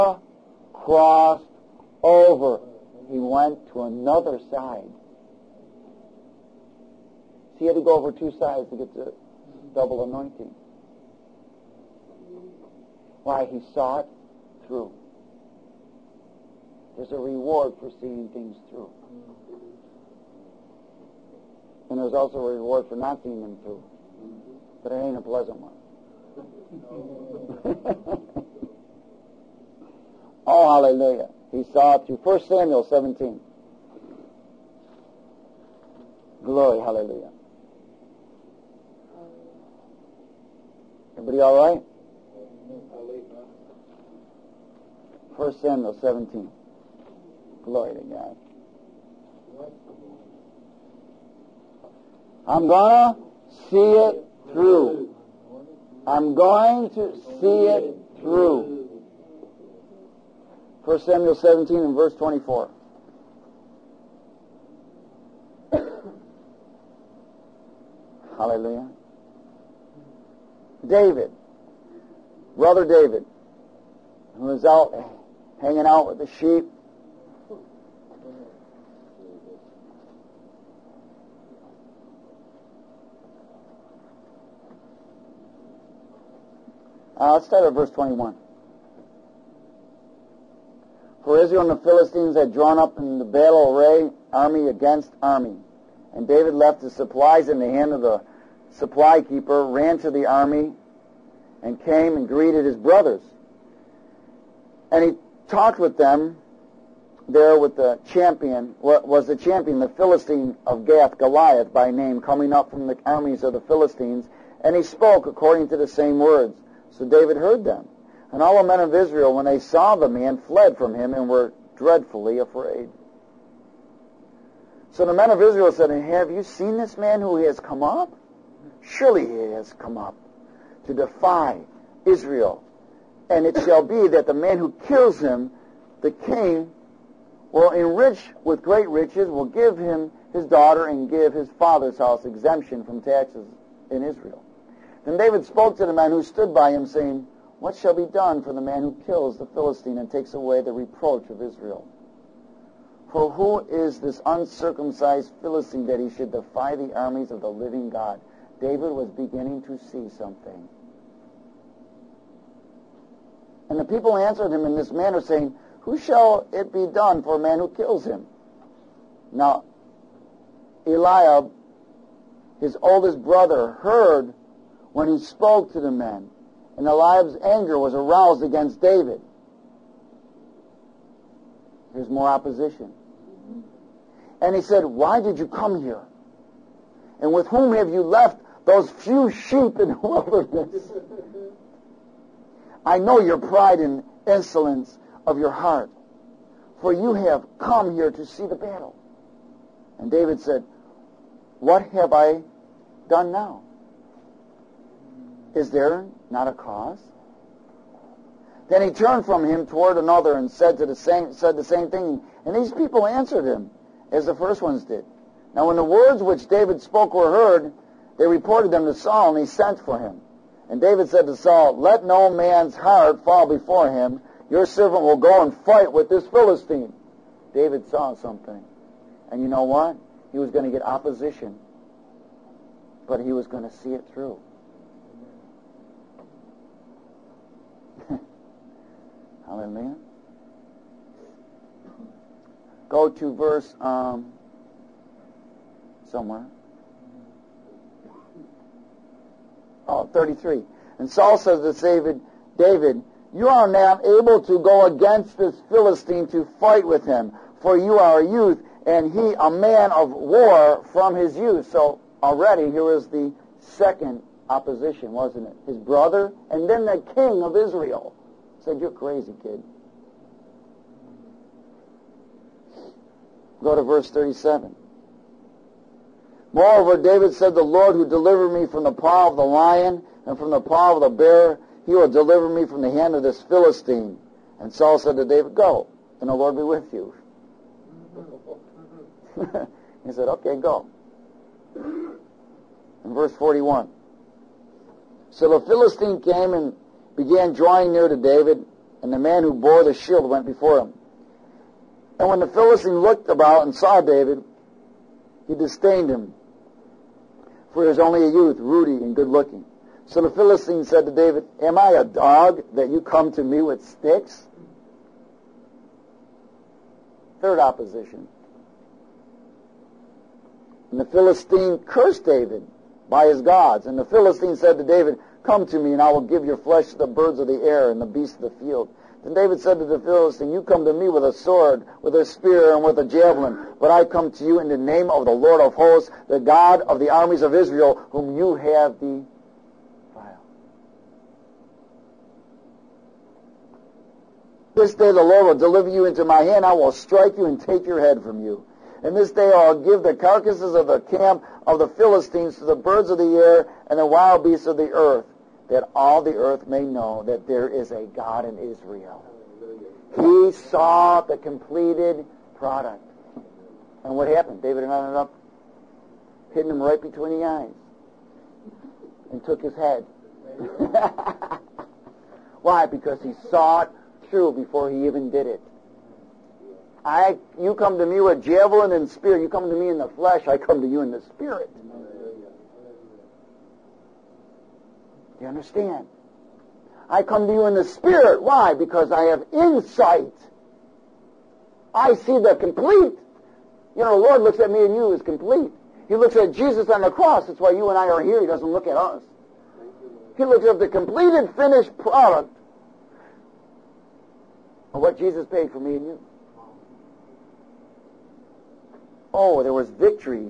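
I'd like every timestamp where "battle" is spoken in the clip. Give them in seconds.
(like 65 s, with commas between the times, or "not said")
93 s, 198 s.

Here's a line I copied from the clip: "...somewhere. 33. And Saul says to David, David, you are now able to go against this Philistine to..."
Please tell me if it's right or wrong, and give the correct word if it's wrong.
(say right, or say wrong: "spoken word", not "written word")
right.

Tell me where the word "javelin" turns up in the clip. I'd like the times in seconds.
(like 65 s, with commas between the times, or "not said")
333 s, 378 s.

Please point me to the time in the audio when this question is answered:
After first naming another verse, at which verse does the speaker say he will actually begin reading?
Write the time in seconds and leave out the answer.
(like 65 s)
87 s.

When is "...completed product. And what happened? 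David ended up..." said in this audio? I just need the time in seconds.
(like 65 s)
361 s.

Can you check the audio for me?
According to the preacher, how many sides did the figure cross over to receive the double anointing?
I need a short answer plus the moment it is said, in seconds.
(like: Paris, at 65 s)
2, at 8 s.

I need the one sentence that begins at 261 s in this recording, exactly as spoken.
So already here is the second opposition, wasn't it?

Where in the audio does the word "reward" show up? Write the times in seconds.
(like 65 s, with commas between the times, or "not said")
17 s, 22 s.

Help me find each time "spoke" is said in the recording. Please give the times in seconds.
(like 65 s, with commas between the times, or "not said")
114 s, 145 s, 175 s, 216 s.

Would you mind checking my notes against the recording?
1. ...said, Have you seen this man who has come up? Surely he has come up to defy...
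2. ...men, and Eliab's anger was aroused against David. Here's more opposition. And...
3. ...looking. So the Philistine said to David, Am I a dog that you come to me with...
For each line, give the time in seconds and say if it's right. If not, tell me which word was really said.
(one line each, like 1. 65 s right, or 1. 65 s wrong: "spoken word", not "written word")
1. 125 s right
2. 175 s right
3. 309 s right.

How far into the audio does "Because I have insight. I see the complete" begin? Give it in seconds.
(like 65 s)
388 s.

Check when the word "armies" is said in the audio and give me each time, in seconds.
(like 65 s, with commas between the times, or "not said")
113 s, 156 s, 337 s.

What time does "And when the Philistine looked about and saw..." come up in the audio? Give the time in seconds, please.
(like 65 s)
302 s.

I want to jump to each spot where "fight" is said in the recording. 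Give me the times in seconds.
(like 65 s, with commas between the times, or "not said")
225 s, 256 s.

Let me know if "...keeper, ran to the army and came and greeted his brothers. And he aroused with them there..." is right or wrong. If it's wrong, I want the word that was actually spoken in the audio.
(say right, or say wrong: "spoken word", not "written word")
wrong: "talked", not "aroused".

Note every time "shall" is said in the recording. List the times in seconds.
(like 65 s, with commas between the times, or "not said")
133 s, 147 s, 165 s.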